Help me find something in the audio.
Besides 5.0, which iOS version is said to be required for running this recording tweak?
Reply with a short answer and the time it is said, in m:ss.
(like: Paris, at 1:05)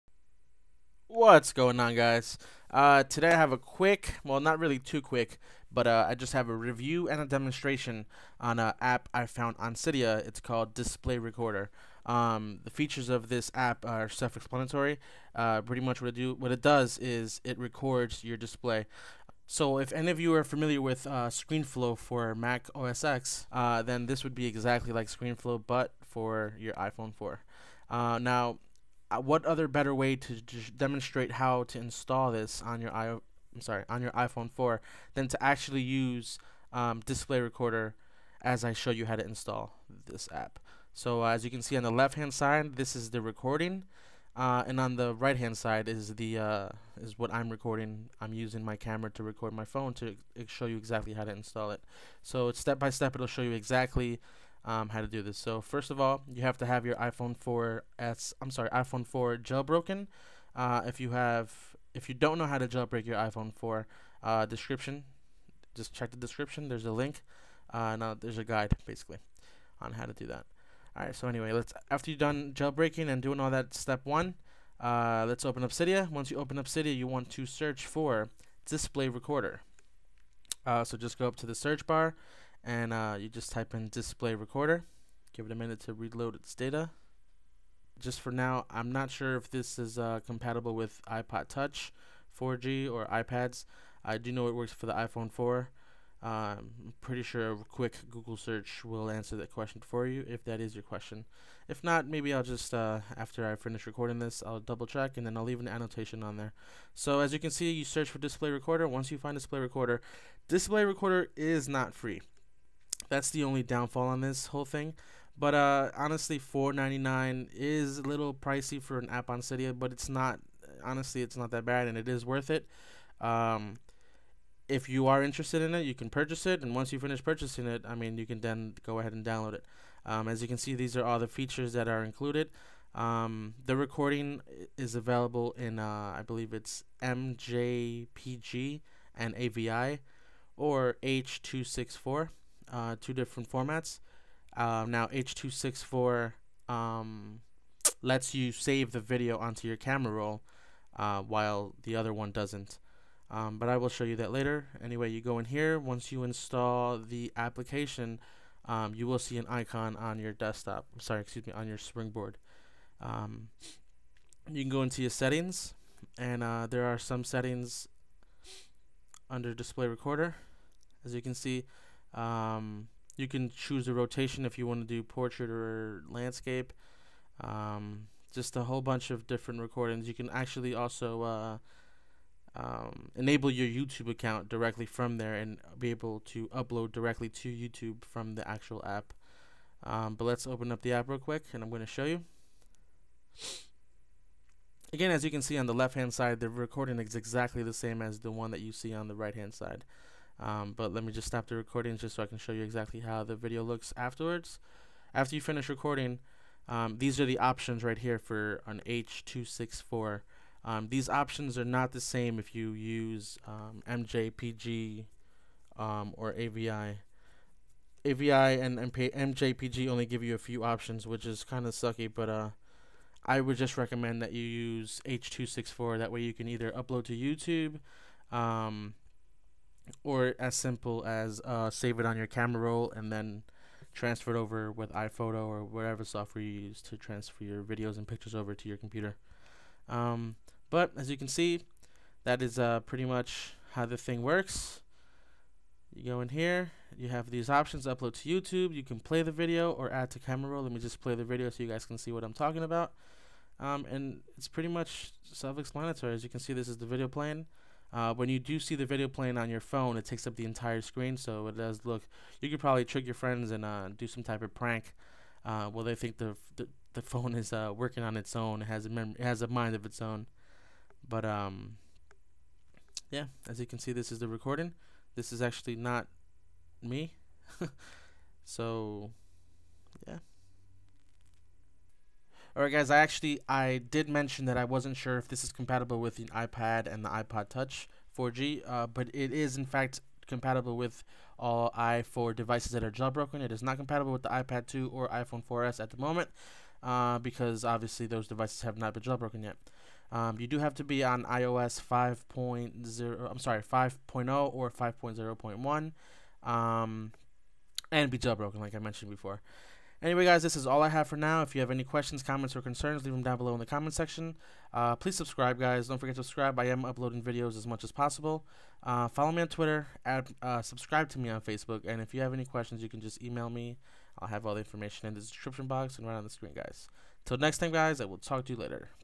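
5.0.1, at 5:04.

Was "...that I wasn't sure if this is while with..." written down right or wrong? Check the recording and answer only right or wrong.
wrong.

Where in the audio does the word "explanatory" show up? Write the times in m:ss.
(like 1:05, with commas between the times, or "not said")
0:14, 4:15.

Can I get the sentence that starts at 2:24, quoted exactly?
Uh, now H.264 two six four um, lets you save the video onto your camera roll uh, while the other one doesn't.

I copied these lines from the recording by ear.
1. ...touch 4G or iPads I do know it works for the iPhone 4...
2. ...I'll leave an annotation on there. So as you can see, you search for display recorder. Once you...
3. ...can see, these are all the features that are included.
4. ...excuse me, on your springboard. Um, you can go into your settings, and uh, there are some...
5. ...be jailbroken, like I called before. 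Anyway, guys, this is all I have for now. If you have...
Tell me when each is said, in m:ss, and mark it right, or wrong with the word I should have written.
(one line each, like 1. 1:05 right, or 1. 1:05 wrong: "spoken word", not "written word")
1. 1:31 right
2. 1:45 right
3. 2:10 right
4. 2:41 right
5. 5:08 wrong: "mentioned", not "called".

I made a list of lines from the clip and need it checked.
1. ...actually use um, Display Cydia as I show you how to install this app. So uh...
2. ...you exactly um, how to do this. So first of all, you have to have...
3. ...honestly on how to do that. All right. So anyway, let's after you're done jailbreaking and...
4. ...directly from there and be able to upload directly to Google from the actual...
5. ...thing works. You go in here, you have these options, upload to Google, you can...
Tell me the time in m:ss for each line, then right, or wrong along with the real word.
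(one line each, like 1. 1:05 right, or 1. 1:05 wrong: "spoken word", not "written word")
1. 0:35 wrong: "Recorder", not "Cydia"
2. 0:53 right
3. 1:08 wrong: "basically", not "honestly"
4. 3:04 wrong: "YouTube", not "Google"
5. 4:03 wrong: "YouTube", not "Google".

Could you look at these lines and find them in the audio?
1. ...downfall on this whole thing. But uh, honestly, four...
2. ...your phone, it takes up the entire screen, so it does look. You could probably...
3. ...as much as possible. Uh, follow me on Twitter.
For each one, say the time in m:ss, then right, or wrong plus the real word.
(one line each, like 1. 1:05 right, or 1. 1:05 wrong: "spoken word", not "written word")
1. 1:53 right
2. 4:19 right
3. 5:17 right.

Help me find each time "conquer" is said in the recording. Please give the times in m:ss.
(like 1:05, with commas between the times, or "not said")
not said.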